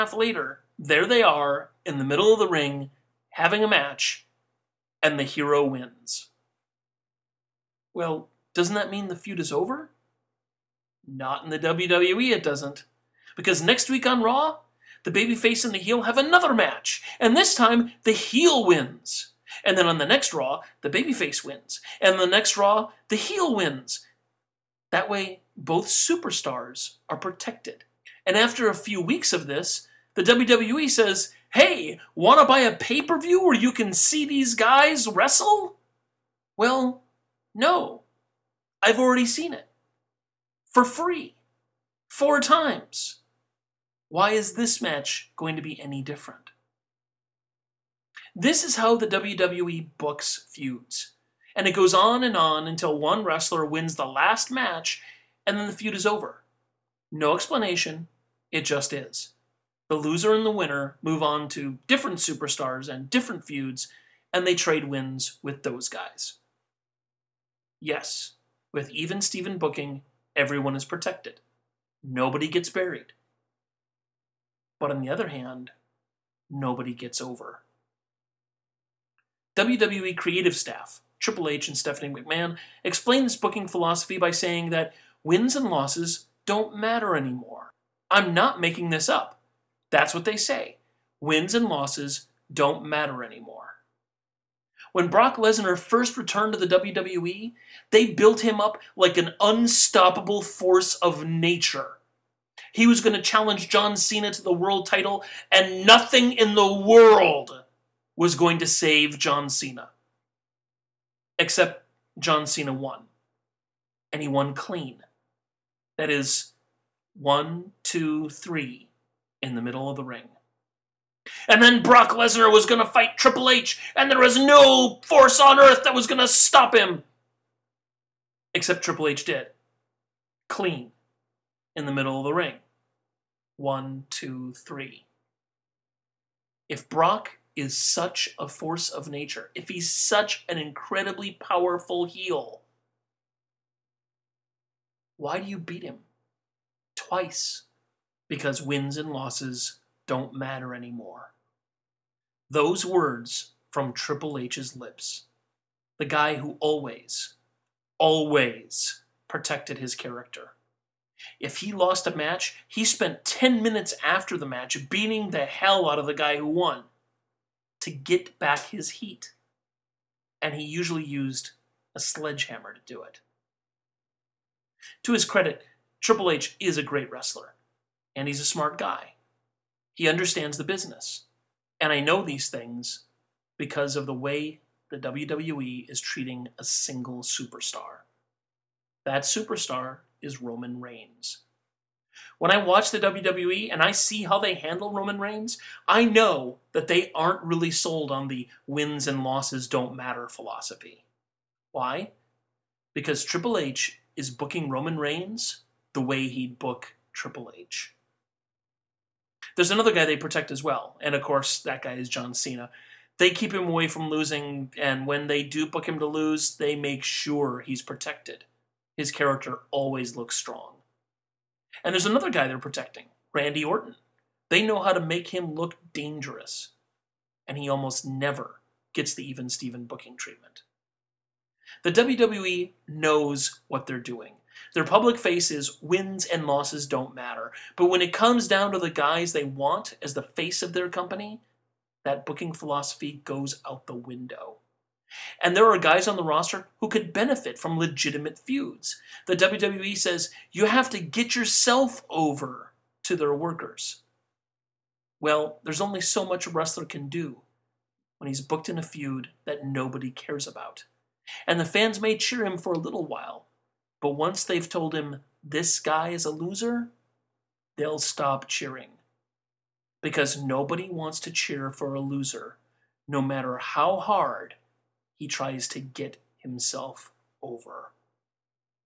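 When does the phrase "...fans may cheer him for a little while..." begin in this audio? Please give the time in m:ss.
4:21.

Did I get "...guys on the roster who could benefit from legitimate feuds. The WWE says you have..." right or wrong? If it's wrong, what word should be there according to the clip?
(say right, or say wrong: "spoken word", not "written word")
right.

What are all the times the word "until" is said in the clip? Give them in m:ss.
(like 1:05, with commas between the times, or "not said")
0:52.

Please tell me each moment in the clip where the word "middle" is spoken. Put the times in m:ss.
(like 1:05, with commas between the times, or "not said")
0:02, 1:59, 2:11.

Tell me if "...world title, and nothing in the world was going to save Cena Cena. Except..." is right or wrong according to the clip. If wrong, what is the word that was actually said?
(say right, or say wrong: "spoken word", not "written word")
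wrong: "John", not "Cena".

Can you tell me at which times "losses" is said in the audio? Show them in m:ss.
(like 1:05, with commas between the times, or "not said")
1:25, 1:31, 2:29, 3:19, 3:56.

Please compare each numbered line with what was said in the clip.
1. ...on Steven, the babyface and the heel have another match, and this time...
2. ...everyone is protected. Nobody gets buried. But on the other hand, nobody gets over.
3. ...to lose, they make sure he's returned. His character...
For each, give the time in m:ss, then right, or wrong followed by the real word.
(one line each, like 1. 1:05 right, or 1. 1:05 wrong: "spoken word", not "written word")
1. 0:14 wrong: "Raw", not "Steven"
2. 1:10 right
3. 3:35 wrong: "protected", not "returned".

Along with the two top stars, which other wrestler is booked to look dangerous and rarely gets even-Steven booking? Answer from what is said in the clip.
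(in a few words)
Randy Orton.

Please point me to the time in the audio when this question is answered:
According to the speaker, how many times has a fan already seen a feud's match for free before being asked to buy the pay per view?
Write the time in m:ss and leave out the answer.
0:42.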